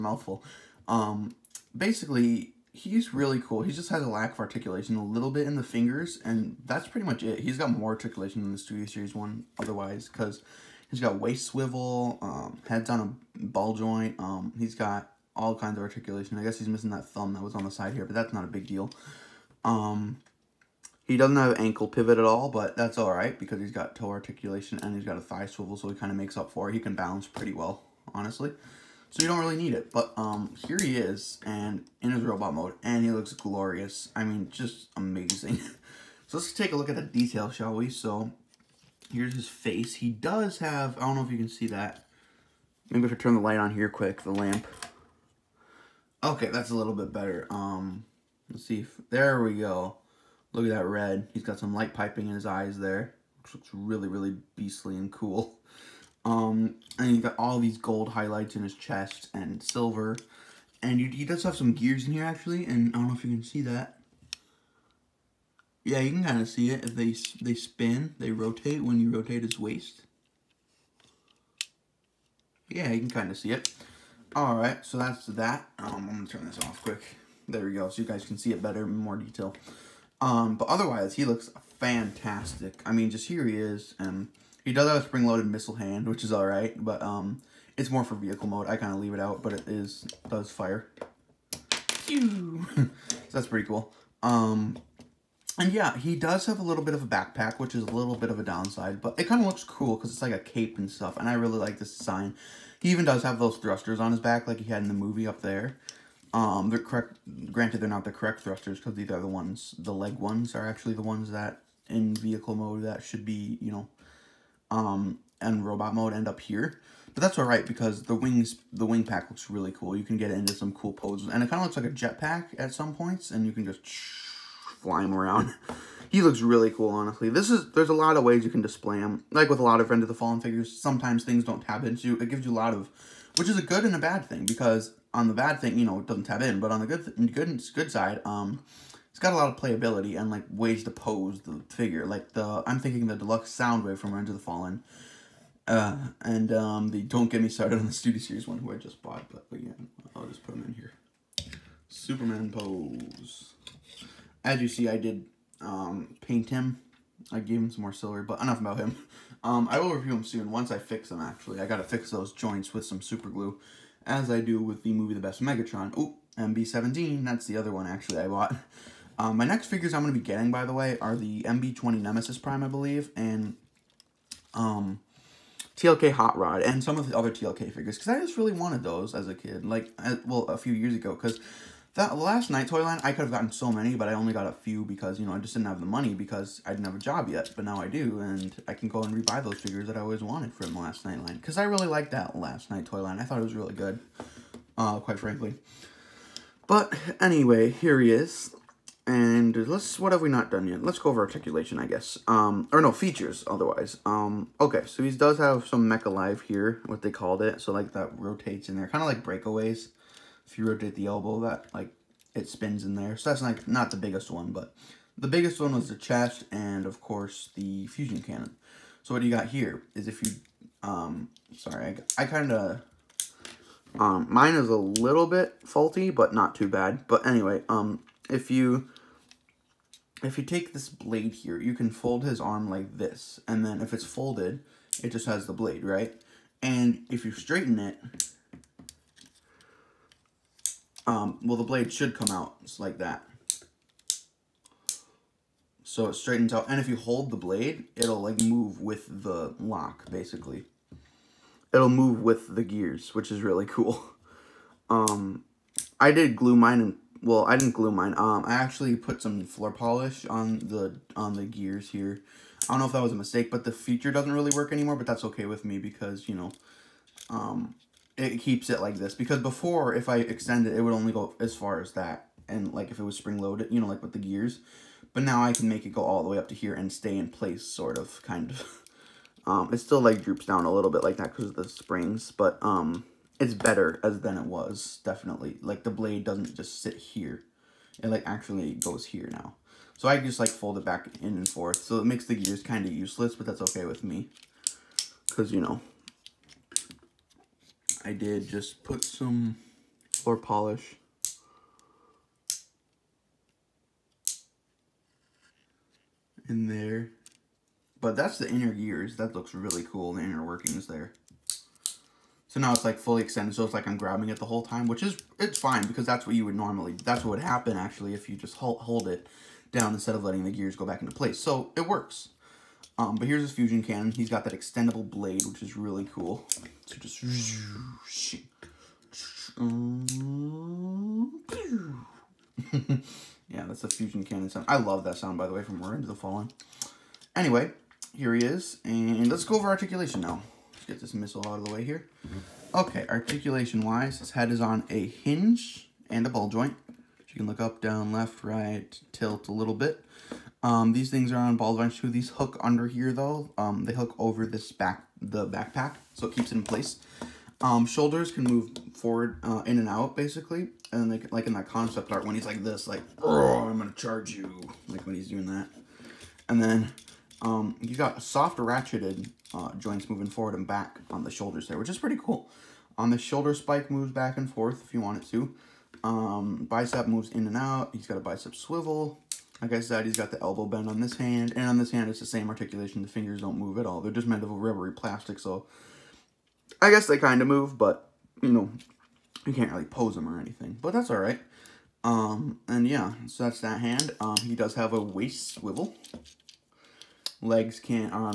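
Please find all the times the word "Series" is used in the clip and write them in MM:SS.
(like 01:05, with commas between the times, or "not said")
00:08, 02:28.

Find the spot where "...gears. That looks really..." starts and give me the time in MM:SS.
05:08.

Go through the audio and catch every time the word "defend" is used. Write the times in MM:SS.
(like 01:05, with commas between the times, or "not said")
not said.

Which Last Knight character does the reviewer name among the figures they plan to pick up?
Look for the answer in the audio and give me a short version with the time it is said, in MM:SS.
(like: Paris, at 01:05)
Hot Rod, at 02:56.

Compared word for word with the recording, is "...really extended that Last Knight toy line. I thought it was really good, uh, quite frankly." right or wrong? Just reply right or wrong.
wrong.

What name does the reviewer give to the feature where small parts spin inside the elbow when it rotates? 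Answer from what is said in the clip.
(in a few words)
Mech Alive.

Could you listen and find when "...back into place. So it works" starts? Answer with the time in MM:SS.
05:20.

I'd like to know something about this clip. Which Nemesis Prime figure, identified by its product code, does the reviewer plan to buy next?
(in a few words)
MB-20.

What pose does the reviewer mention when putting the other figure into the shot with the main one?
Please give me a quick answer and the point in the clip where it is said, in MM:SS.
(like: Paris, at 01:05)
Superman pose, at 02:31.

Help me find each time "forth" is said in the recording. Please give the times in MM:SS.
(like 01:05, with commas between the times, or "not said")
04:51, 06:14.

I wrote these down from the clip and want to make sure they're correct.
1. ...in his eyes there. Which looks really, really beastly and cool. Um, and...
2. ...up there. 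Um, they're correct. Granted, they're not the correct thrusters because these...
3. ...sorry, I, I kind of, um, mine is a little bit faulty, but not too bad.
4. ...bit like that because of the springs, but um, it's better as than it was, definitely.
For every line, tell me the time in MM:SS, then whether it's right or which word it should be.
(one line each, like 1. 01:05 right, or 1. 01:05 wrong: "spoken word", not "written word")
1. 00:52 right
2. 01:45 right
3. 03:41 right
4. 04:40 right.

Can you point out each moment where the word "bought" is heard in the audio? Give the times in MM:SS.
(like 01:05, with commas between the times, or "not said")
02:29, 02:48.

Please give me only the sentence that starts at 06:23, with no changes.
The fingers don't move at all.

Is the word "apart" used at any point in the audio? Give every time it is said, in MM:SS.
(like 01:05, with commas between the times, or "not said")
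not said.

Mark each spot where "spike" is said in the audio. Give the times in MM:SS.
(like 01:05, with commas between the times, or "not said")
06:13.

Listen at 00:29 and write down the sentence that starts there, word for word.
But um, here he is and in his robot mode, and he looks glorious.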